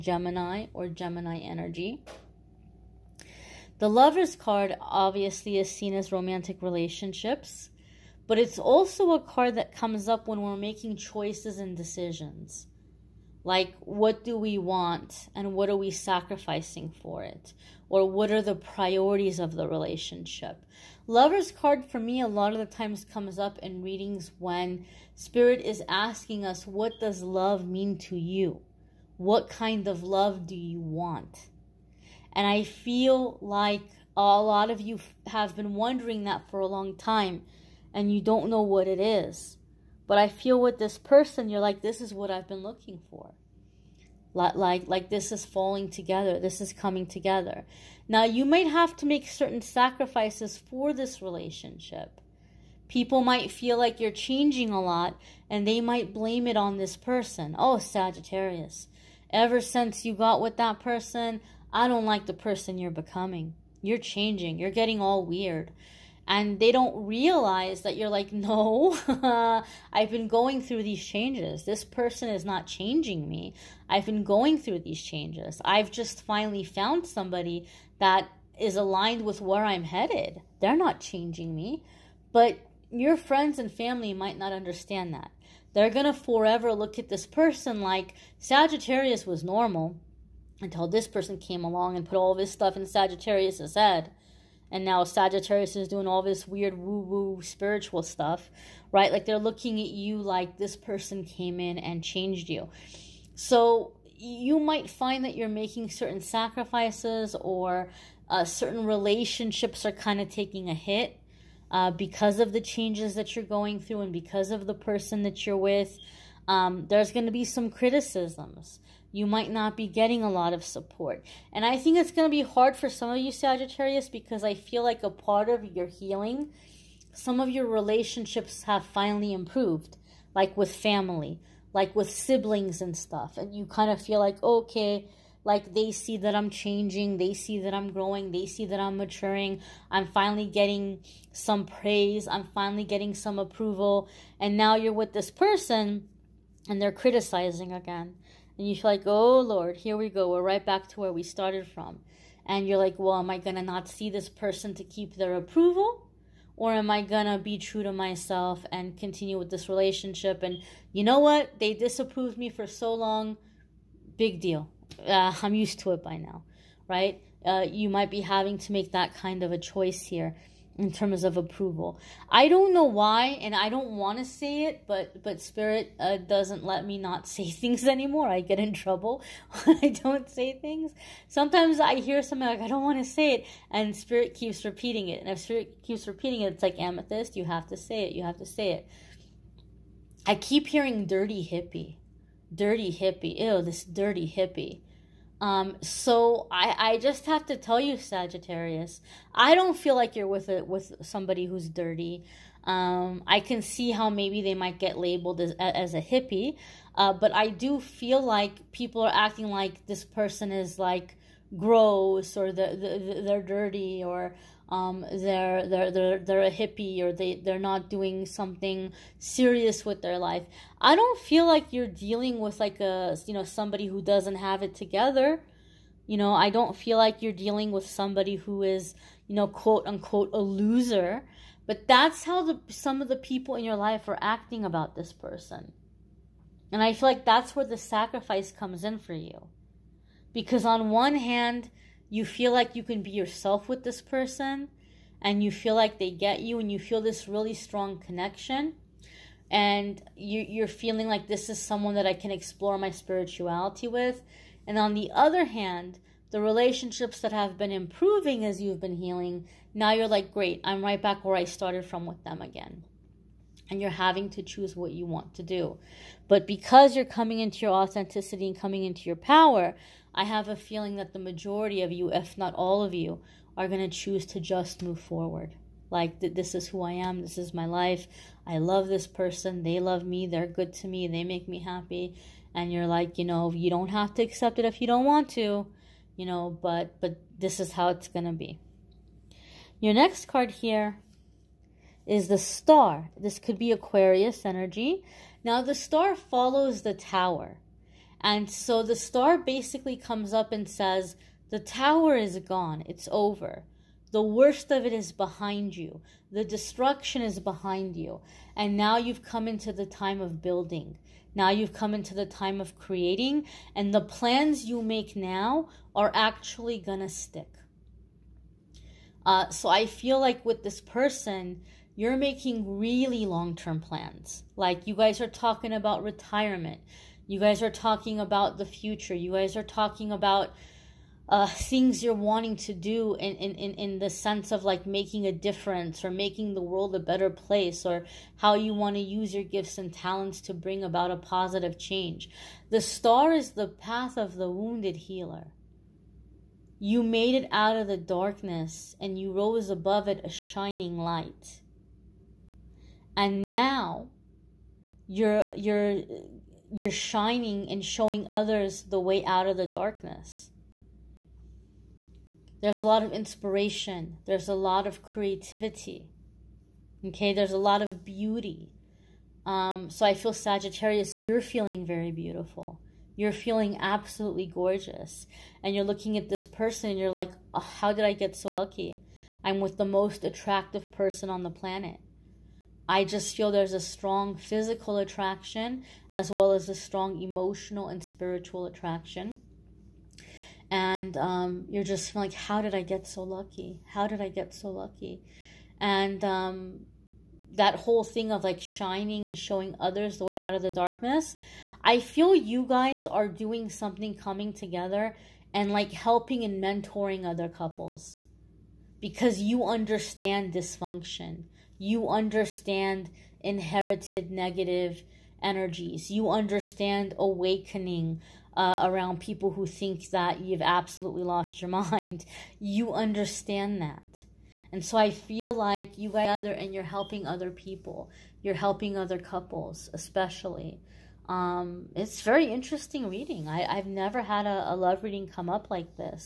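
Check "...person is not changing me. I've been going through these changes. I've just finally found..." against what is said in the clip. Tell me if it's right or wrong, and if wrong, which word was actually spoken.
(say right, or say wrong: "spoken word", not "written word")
right.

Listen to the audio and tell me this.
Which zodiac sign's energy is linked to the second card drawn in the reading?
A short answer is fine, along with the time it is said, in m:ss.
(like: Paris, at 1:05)
Aquarius, at 4:53.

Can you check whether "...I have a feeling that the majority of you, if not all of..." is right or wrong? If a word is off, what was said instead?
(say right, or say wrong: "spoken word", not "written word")
right.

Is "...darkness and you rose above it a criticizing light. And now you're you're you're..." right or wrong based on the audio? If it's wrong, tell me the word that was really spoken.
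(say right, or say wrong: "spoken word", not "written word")
wrong: "shining", not "criticizing".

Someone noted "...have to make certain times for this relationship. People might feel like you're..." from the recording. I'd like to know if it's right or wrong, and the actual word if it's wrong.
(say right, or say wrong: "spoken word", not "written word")
wrong: "sacrifices", not "times".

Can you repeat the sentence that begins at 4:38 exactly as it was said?
I love this person, they love me, they're good to me, they make me happy.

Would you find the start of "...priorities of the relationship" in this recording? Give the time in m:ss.
0:18.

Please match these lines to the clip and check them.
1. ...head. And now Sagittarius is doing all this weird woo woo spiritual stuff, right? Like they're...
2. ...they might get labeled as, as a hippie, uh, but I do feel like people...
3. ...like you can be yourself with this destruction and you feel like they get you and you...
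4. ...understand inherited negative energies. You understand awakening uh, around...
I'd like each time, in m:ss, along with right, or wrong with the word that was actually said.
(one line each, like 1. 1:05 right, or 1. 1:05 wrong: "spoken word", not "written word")
1. 1:33 right
2. 3:24 right
3. 4:02 wrong: "person", not "destruction"
4. 6:52 right.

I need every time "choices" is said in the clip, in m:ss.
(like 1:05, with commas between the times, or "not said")
0:10, 2:49.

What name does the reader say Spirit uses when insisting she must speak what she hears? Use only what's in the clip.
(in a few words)
Amethyst.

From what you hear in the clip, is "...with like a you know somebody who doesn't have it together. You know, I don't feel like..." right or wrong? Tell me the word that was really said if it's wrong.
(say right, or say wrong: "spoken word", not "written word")
right.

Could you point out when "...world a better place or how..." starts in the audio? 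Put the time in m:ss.
5:36.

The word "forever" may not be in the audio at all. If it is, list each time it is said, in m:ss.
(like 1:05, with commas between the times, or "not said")
1:26.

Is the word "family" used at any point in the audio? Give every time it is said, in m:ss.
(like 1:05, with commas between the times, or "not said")
1:23, 2:10.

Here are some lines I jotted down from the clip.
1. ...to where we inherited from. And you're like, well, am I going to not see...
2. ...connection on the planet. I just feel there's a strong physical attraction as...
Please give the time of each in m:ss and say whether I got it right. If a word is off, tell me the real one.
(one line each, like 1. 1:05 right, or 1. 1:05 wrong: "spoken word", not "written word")
1. 2:30 wrong: "started", not "inherited"
2. 6:20 wrong: "person", not "connection".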